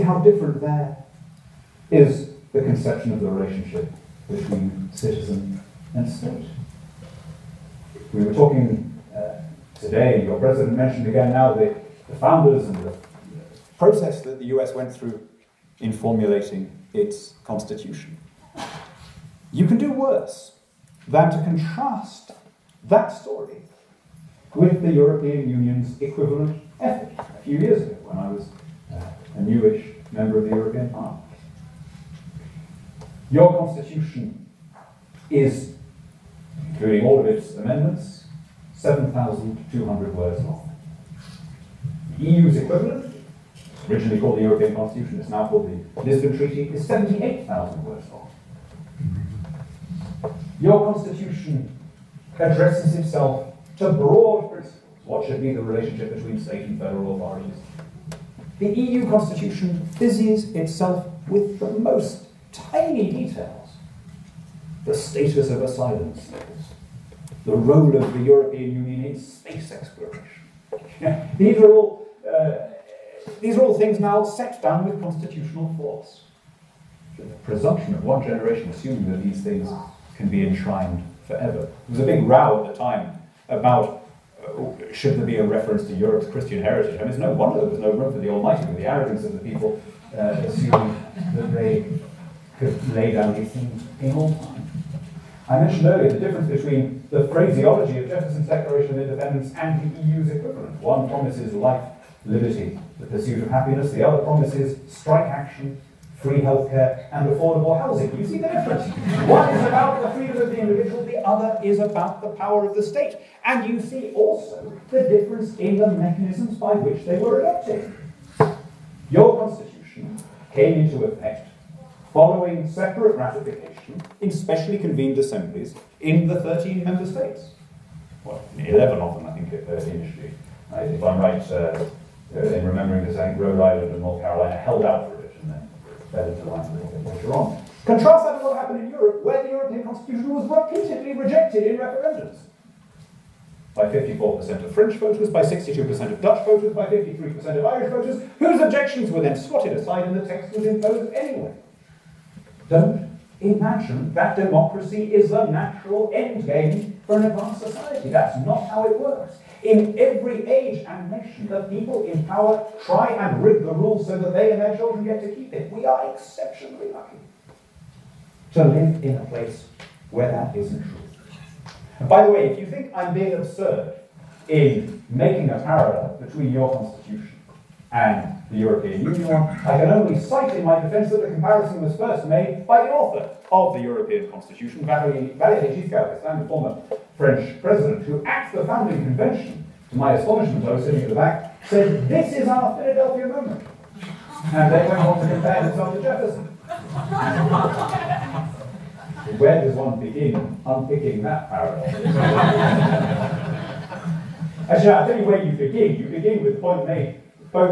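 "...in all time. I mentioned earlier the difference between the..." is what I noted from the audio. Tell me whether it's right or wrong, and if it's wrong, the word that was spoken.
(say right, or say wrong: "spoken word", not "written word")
right.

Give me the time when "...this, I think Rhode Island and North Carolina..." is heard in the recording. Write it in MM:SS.
02:13.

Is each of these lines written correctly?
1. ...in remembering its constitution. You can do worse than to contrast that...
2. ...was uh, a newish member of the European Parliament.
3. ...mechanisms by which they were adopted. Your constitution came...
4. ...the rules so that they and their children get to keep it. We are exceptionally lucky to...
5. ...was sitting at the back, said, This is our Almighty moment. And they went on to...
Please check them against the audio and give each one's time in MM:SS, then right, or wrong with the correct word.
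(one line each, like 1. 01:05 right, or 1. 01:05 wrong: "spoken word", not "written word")
1. 00:15 wrong: "formulating", not "remembering"
2. 00:28 right
3. 01:55 right
4. 02:43 right
5. 03:10 wrong: "Philadelphia", not "Almighty".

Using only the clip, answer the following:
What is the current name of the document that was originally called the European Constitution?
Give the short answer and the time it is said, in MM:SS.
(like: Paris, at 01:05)
Lisbon Treaty, at 00:46.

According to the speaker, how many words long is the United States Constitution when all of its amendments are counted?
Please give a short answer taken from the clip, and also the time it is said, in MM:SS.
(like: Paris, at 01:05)
7,200, at 00:38.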